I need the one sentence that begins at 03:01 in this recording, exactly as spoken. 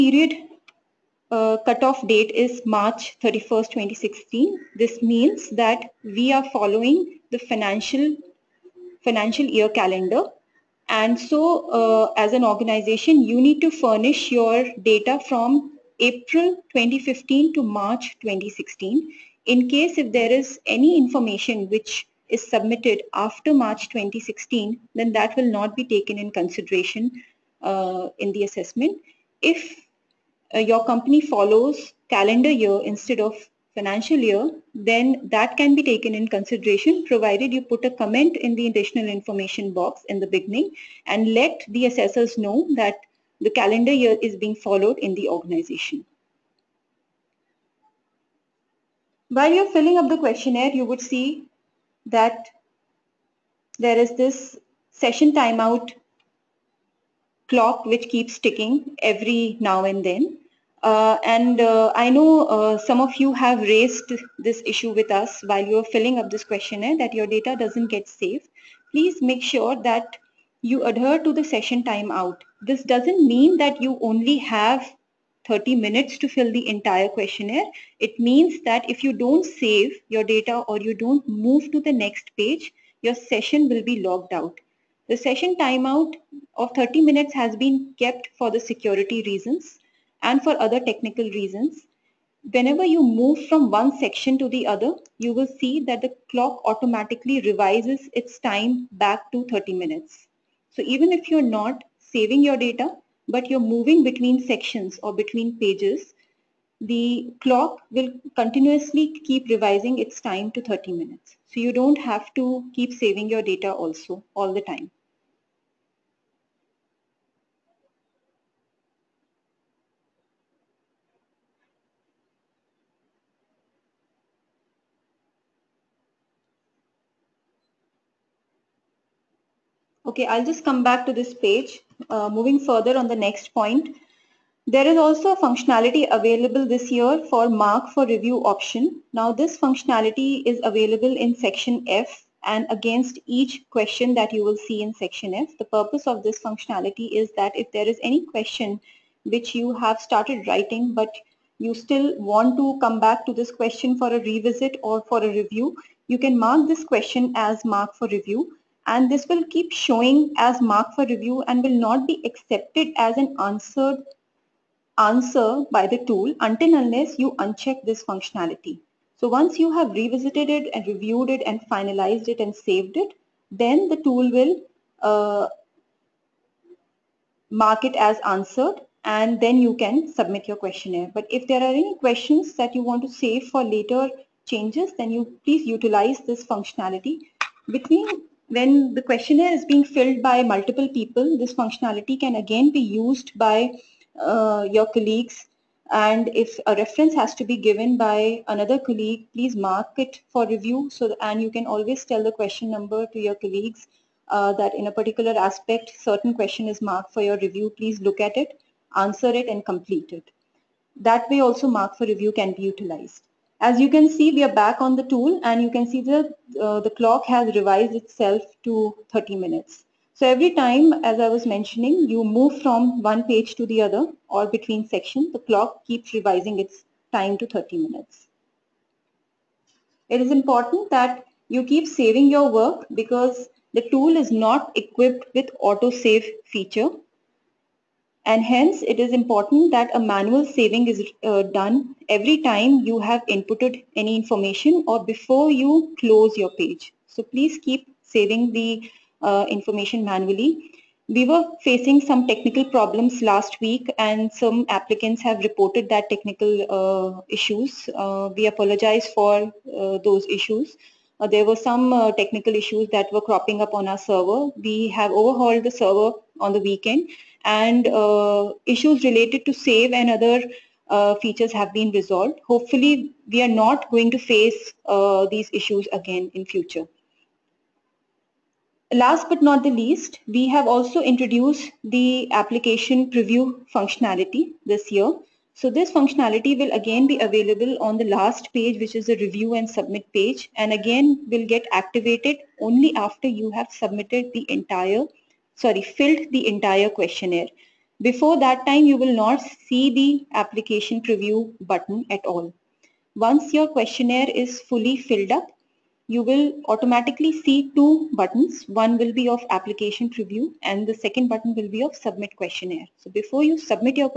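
But if there are any questions that you want to save for later changes, then you please utilize this functionality.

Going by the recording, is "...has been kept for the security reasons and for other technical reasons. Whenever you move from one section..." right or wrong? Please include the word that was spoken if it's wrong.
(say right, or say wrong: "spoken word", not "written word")
right.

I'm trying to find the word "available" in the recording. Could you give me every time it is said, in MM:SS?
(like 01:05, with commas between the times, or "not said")
02:16, 02:20, 04:47.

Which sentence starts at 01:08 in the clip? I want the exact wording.
Please make sure that you adhere to the session timeout.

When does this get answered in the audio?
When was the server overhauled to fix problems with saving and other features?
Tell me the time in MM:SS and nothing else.
04:26.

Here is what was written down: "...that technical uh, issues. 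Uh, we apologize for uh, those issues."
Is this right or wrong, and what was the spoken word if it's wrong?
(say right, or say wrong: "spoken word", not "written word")
right.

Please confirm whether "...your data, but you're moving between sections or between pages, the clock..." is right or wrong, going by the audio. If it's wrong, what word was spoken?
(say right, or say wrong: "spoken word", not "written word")
right.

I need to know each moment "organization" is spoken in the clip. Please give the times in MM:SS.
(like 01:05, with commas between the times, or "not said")
00:12, 00:45.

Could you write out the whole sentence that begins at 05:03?
Once your questionnaire is fully filled up, you will automatically see two buttons.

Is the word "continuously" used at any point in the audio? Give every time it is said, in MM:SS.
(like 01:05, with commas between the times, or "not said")
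01:48.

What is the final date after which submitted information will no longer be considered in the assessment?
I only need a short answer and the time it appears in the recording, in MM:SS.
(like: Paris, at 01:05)
March 31st, 2016, at 00:02.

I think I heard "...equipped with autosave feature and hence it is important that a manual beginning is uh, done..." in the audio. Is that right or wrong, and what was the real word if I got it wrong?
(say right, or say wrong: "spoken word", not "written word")
wrong: "saving", not "beginning".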